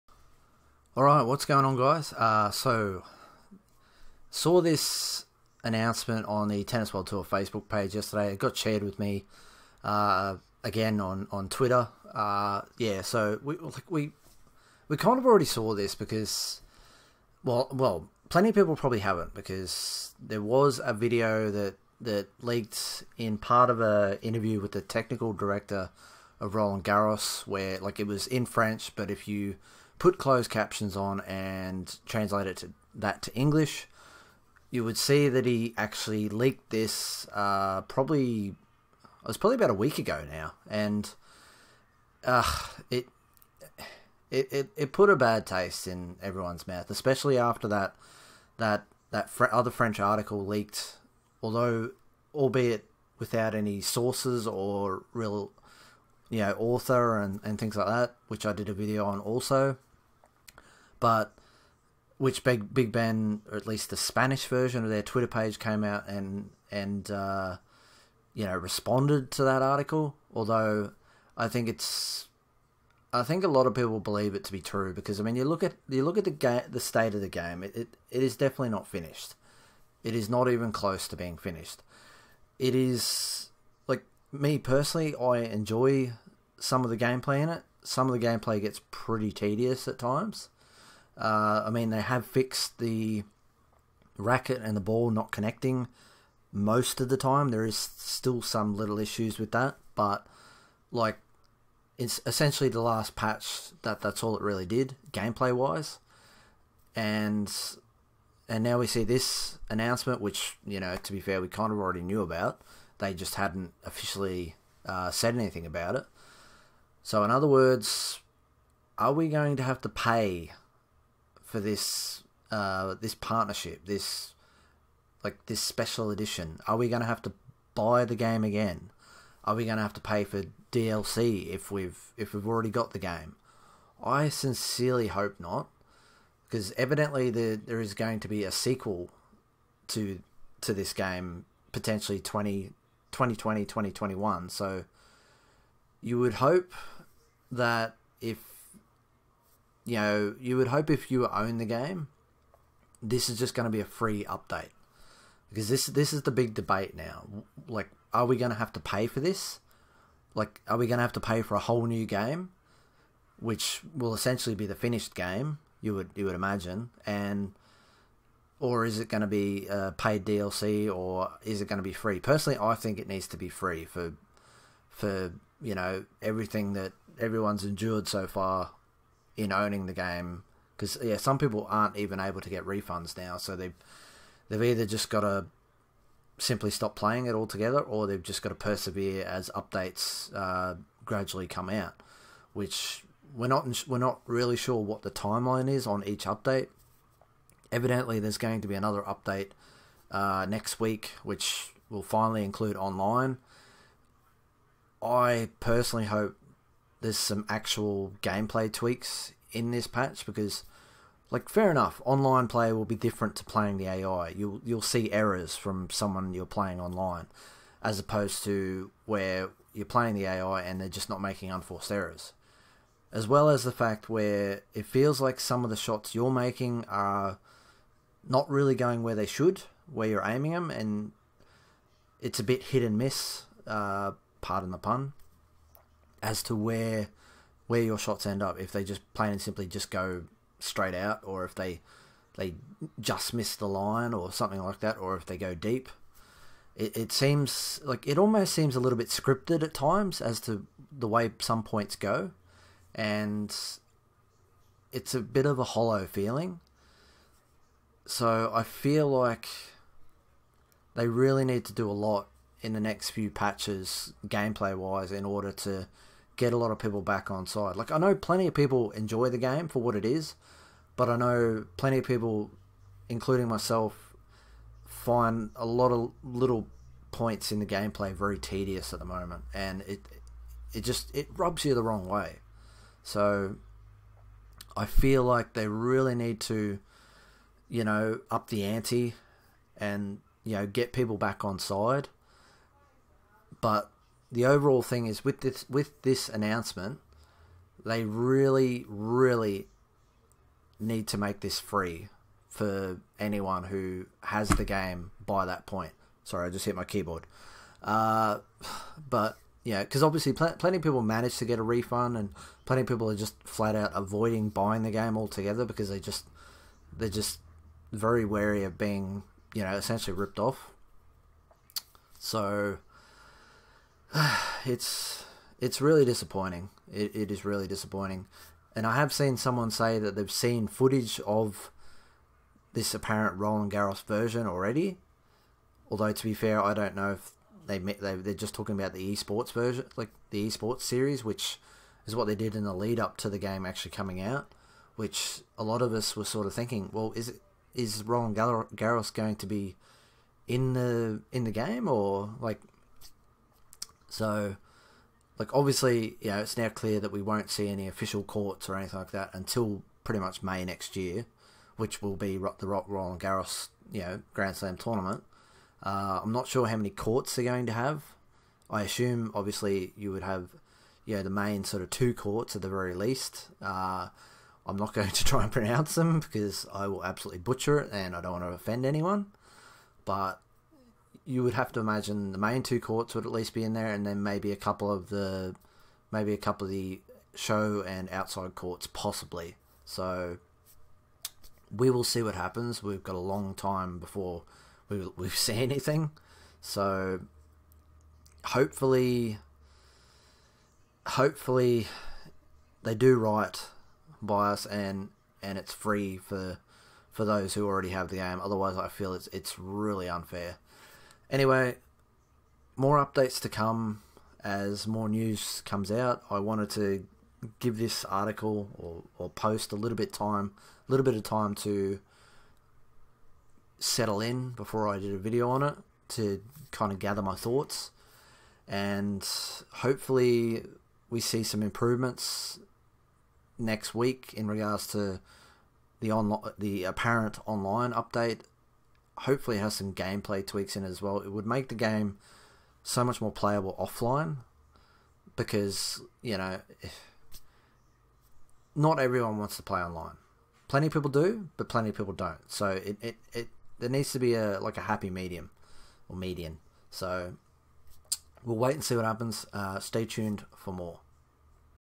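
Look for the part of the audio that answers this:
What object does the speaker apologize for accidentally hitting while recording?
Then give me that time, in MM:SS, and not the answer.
05:06.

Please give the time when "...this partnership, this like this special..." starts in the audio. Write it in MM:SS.
02:03.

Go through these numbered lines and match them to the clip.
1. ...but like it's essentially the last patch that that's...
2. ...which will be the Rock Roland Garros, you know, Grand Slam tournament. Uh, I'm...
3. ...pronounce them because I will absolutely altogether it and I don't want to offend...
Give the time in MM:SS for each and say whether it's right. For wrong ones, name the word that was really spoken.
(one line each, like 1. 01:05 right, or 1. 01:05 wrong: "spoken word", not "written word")
1. 01:39 right
2. 06:01 right
3. 06:15 wrong: "butcher", not "altogether".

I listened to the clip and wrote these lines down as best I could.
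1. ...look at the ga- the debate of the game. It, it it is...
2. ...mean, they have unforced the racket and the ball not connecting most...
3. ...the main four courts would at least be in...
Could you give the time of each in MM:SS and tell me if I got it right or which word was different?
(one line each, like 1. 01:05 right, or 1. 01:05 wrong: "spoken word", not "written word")
1. 01:16 wrong: "state", not "debate"
2. 01:31 wrong: "fixed", not "unforced"
3. 06:22 wrong: "two", not "four".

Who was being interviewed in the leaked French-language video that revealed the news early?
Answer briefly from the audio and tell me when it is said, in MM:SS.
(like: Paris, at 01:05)
Technical director of Roland Garros, at 00:24.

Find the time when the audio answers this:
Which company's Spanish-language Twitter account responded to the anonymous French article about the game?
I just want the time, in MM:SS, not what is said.
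01:02.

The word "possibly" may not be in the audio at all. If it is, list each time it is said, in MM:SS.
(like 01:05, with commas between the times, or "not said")
06:28.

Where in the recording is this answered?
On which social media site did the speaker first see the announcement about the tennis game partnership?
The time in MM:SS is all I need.
00:06.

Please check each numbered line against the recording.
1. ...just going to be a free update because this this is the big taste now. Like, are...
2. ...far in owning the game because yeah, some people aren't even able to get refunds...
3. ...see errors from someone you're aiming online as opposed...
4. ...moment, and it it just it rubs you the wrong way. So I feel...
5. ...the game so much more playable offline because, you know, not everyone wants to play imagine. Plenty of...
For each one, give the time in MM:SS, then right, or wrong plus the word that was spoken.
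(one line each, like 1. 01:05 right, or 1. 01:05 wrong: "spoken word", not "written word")
1. 02:33 wrong: "debate", not "taste"
2. 02:58 right
3. 03:34 wrong: "playing", not "aiming"
4. 04:39 right
5. 07:21 wrong: "online", not "imagine".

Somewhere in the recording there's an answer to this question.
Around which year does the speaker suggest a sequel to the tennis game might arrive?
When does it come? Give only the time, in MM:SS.
02:23.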